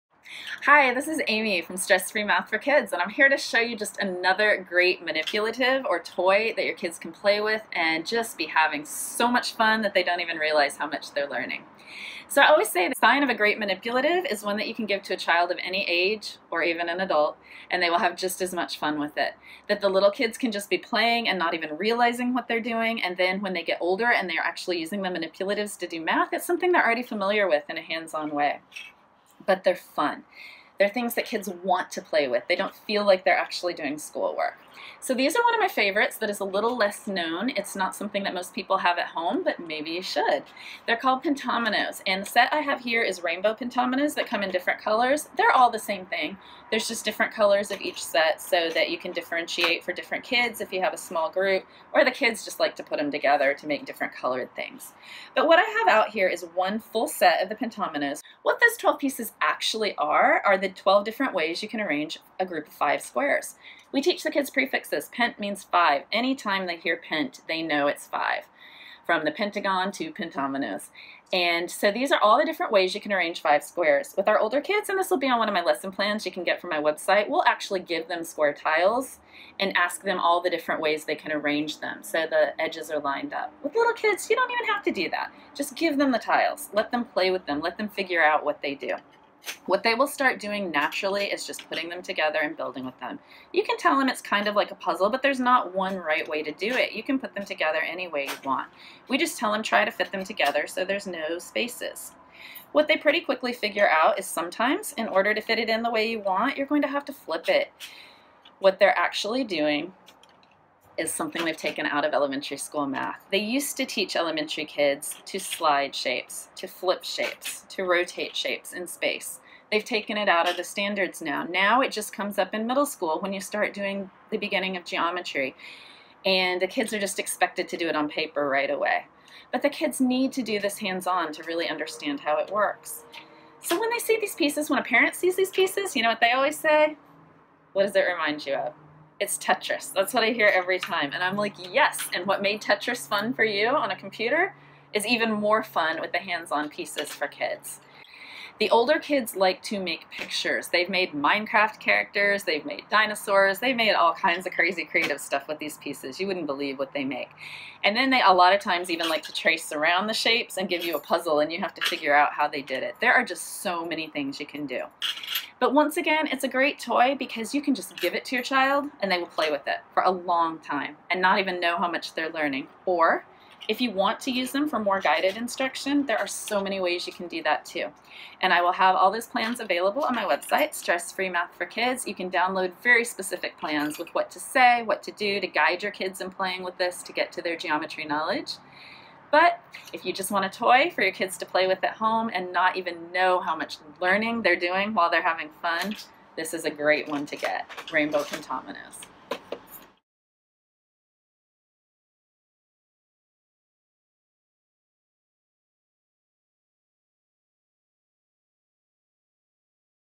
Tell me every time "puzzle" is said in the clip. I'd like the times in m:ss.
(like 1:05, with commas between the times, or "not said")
1:34, 2:40.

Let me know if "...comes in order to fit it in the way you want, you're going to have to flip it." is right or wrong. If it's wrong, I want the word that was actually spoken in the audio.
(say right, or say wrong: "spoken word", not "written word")
wrong: "sometimes", not "comes".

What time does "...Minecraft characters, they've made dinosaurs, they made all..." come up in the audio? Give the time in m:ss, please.
2:31.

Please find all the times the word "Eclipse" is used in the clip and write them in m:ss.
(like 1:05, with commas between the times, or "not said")
not said.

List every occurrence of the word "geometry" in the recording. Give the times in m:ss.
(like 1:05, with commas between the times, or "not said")
2:04, 3:07.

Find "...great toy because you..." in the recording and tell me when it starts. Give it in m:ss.
2:46.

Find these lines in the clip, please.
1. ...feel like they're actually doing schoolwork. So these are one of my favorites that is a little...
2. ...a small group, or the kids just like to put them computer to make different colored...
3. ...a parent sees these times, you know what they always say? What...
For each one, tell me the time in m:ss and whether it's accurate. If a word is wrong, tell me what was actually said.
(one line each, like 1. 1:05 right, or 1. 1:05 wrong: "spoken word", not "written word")
1. 0:32 right
2. 0:50 wrong: "together", not "computer"
3. 2:14 wrong: "pieces", not "times".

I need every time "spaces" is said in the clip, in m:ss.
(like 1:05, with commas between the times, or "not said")
1:41, 1:58.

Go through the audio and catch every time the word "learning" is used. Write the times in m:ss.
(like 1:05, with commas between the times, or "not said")
0:11, 2:52, 3:14.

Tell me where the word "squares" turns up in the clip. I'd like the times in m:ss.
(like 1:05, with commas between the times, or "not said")
1:03, 1:13, 1:18.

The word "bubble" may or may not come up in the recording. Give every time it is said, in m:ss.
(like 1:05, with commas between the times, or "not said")
not said.